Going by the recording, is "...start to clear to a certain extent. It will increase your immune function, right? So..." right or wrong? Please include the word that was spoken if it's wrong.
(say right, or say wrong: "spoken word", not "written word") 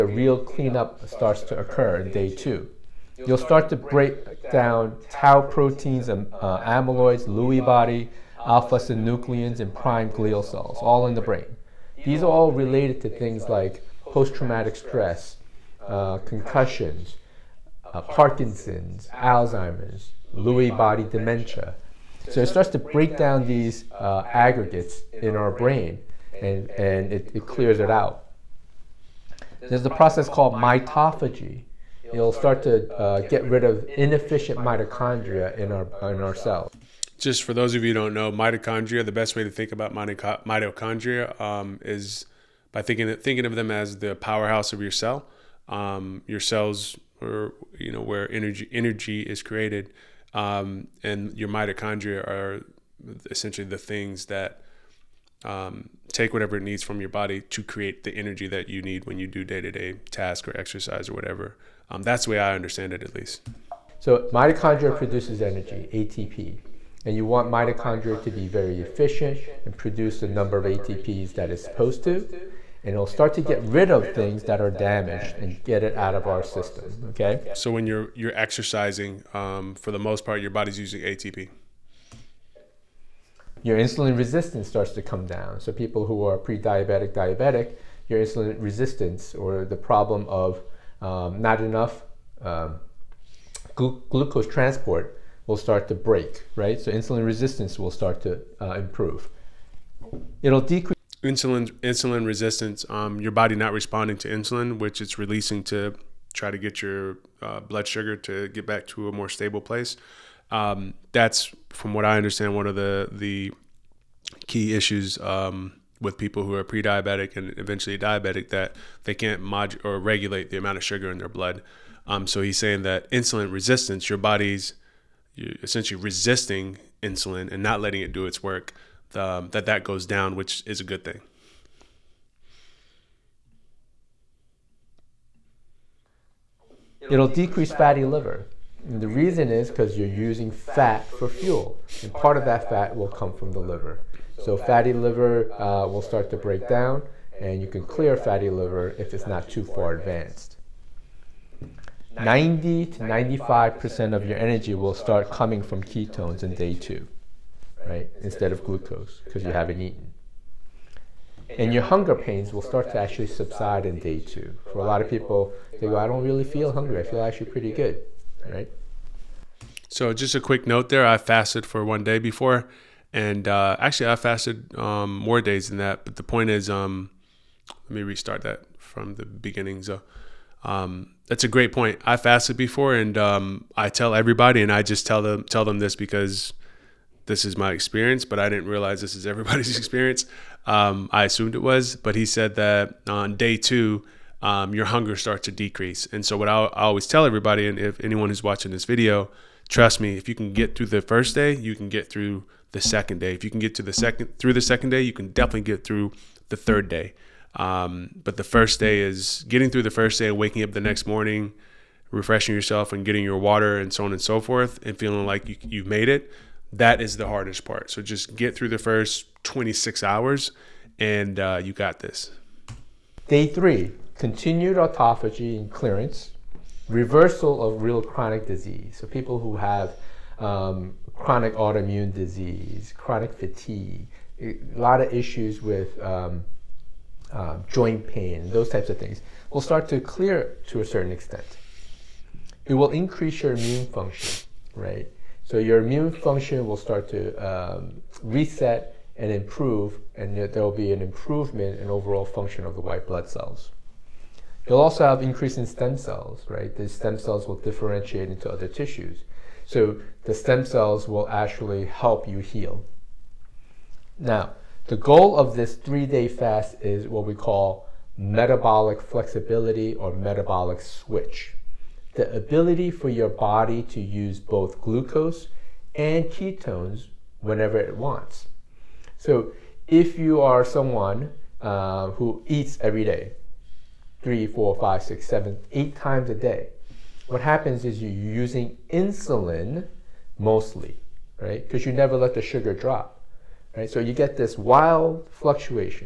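right.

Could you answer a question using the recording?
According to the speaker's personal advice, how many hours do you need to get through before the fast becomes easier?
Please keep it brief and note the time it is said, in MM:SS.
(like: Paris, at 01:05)
26 hours, at 03:39.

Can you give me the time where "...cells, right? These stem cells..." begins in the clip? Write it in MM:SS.
04:15.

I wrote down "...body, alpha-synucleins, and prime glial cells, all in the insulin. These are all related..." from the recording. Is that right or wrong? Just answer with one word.
wrong.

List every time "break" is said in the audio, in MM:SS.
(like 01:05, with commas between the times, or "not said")
00:03, 00:22, 01:35, 02:26.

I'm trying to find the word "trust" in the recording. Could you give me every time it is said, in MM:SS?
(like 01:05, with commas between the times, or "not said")
03:19.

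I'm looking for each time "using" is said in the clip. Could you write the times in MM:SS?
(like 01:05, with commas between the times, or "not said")
01:20, 02:20, 04:48.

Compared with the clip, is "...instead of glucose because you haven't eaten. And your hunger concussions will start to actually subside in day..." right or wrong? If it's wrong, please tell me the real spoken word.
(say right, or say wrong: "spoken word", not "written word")
wrong: "pains", not "concussions".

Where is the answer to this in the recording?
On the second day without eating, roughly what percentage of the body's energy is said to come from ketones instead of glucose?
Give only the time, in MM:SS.
02:32.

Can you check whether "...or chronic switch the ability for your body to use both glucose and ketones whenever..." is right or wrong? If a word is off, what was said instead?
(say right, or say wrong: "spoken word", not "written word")
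wrong: "metabolic", not "chronic".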